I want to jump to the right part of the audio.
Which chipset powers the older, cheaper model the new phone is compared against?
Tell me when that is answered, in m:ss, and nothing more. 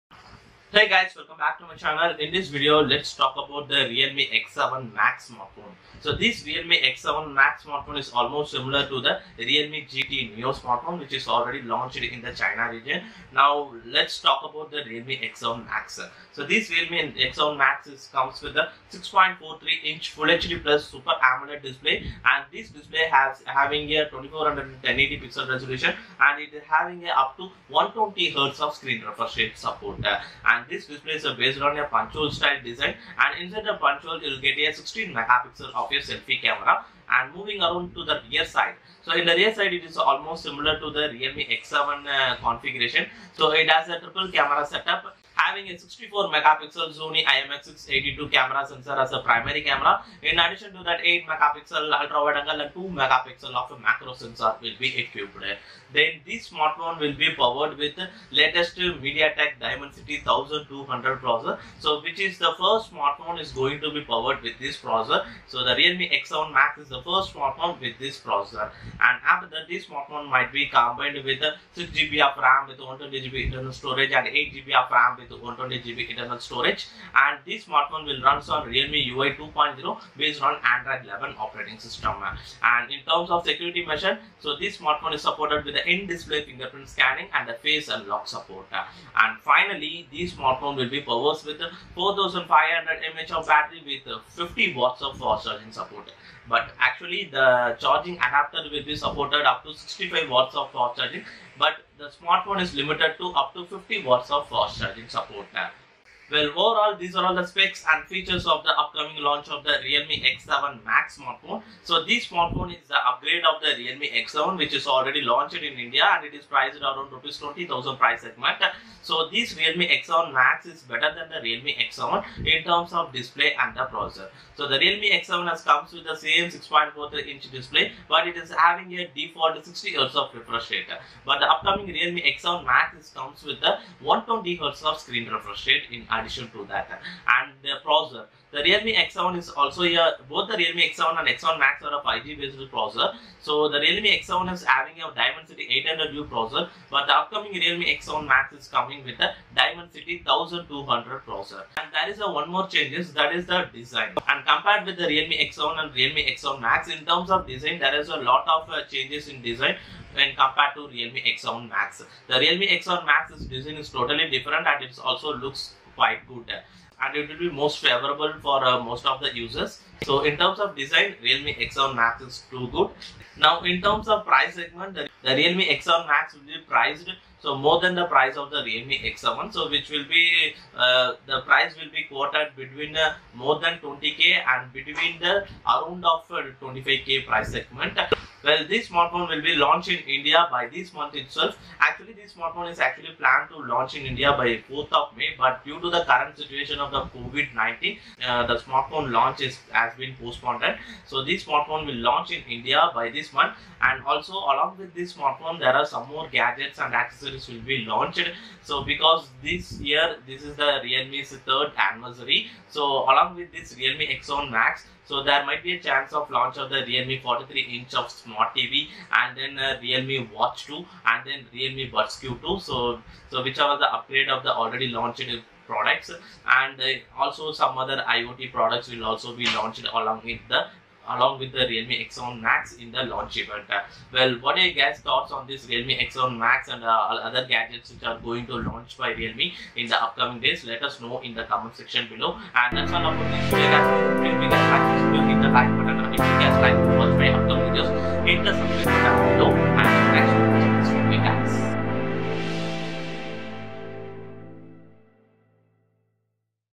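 2:25.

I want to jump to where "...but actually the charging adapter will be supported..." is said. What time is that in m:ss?
1:36.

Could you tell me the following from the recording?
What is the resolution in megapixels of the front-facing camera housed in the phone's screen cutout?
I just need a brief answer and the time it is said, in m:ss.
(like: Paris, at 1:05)
16 megapixel, at 0:34.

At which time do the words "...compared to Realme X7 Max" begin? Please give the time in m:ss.
2:40.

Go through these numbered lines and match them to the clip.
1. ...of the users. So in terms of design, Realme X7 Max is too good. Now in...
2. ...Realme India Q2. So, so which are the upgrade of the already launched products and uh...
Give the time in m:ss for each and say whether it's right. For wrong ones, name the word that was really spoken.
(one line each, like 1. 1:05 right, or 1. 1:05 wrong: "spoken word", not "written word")
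1. 2:49 right
2. 3:41 wrong: "Buds", not "India".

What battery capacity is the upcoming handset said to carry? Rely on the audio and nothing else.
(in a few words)
4500 mAh.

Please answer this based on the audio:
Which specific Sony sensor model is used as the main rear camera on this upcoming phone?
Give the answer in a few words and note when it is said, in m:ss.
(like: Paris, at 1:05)
Sony IMX682, at 0:46.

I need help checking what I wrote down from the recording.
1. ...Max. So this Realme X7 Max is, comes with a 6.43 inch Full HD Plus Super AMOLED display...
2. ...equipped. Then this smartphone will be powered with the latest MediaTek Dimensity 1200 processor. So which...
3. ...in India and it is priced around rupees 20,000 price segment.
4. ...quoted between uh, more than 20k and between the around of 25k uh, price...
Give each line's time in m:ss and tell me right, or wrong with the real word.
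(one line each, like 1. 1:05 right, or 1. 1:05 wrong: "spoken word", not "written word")
1. 0:15 right
2. 0:54 right
3. 1:55 right
4. 3:02 right.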